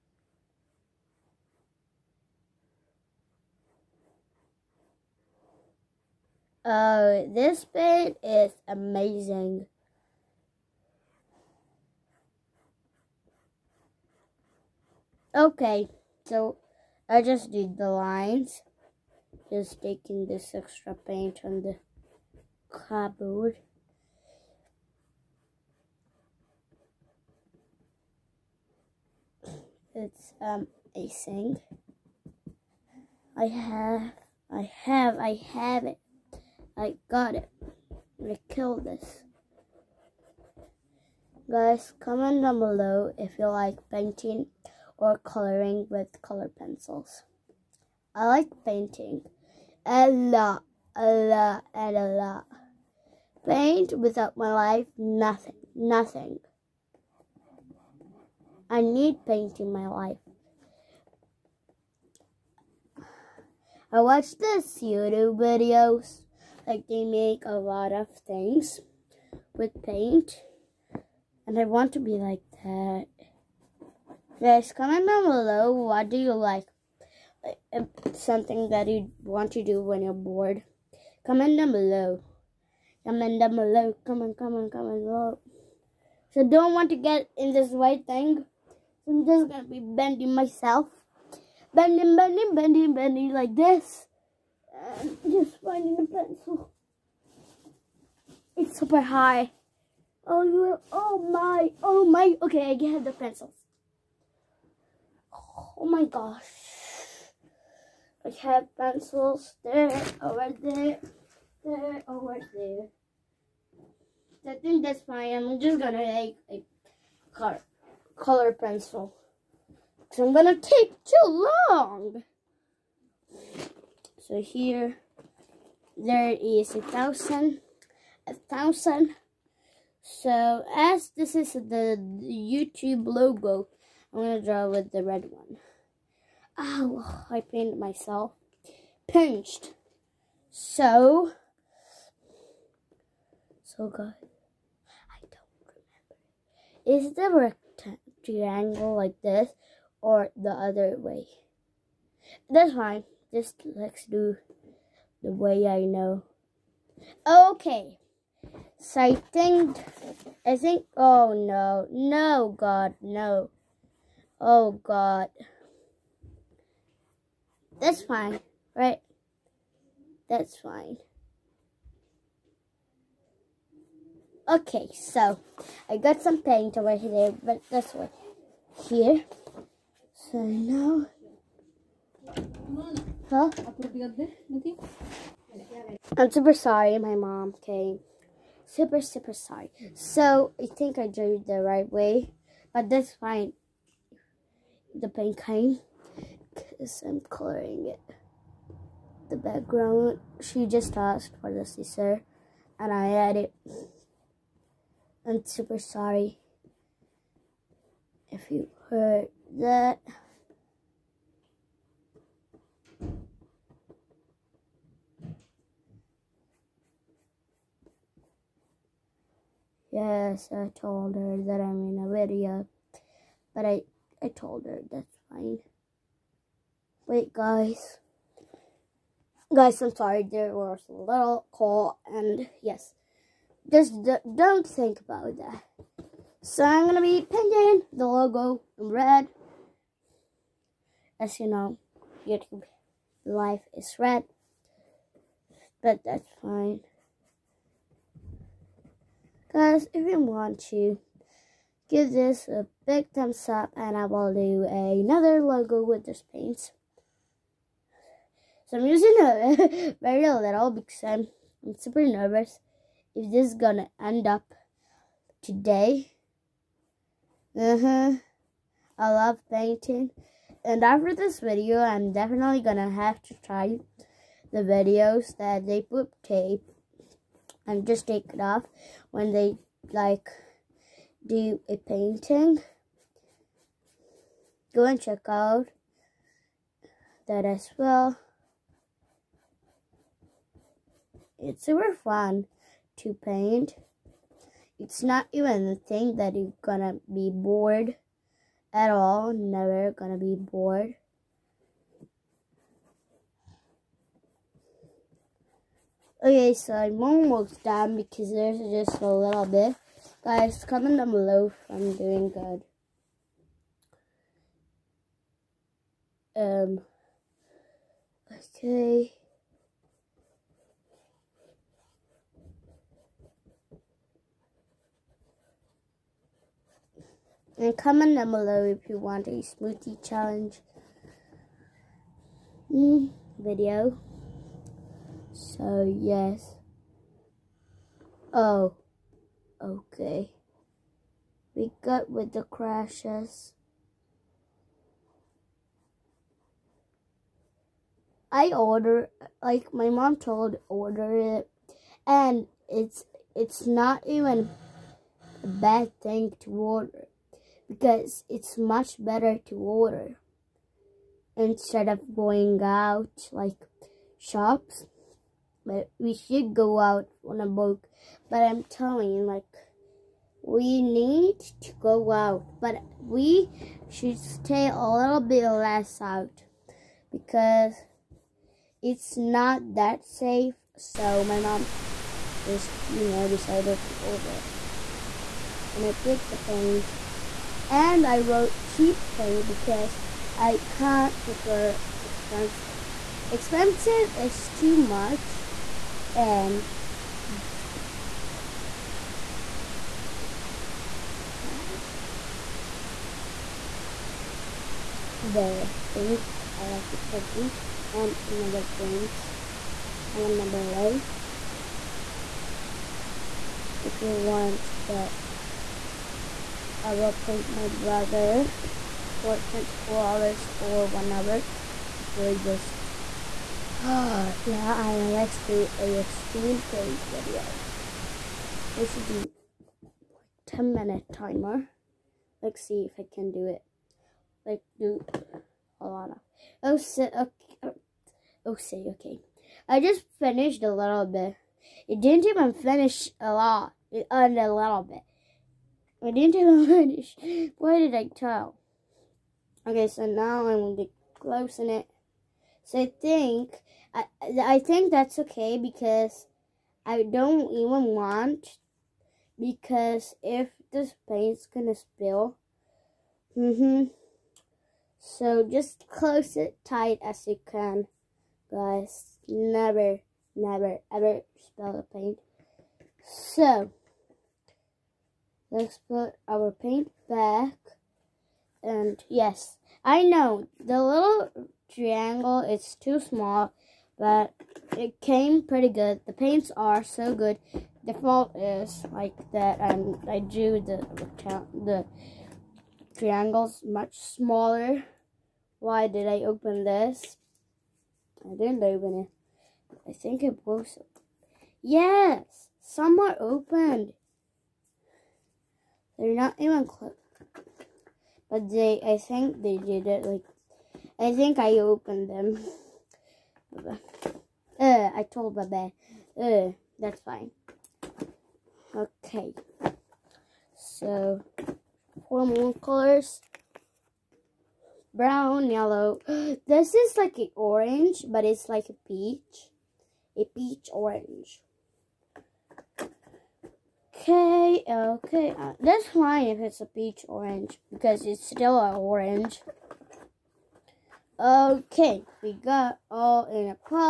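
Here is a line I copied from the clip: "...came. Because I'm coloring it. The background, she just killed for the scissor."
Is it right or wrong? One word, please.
wrong.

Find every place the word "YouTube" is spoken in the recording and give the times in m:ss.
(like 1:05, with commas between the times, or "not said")
1:04, 2:12, 4:02.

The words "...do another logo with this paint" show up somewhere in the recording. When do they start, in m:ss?
4:14.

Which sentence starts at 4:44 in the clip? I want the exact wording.
Go and check out that as well.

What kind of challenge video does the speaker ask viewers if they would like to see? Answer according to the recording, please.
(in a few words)
smoothie challenge.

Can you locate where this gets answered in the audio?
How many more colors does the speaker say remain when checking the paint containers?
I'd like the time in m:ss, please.
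8:42.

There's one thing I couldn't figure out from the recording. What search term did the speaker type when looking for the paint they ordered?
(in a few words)
cheap paint.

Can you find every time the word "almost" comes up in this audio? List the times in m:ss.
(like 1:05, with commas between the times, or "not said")
5:07.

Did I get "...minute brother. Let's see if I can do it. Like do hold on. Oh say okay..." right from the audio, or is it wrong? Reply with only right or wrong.
wrong.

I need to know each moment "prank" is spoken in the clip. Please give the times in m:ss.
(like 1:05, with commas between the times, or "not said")
6:48, 6:57, 7:06.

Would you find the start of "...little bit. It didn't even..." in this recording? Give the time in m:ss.
7:20.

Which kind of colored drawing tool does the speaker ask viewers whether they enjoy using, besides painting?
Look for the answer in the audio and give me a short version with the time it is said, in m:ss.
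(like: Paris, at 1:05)
color pencils, at 0:46.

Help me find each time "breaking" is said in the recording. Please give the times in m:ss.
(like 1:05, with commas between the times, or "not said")
6:42.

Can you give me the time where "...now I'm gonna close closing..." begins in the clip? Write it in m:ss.
7:30.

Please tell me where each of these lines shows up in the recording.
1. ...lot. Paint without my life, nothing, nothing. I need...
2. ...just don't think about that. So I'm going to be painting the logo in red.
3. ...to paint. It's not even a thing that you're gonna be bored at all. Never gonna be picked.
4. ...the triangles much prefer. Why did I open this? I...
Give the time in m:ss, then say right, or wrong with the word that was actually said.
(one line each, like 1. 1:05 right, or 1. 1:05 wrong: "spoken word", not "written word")
1. 0:52 right
2. 3:53 right
3. 4:52 wrong: "bored", not "picked"
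4. 8:11 wrong: "smaller", not "prefer".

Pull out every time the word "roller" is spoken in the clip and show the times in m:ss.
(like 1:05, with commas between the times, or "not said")
not said.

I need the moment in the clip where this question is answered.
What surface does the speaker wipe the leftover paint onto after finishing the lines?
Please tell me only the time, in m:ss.
0:22.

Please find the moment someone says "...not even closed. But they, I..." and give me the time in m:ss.
8:26.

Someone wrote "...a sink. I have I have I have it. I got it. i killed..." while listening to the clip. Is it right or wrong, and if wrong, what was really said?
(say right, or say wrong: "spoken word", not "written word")
right.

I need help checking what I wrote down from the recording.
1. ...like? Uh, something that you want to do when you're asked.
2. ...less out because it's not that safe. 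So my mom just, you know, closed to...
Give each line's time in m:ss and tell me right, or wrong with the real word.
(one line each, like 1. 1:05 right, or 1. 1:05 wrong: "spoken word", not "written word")
1. 1:16 wrong: "bored", not "asked"
2. 6:15 wrong: "decided", not "closed".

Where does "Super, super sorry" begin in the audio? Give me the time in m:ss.
3:08.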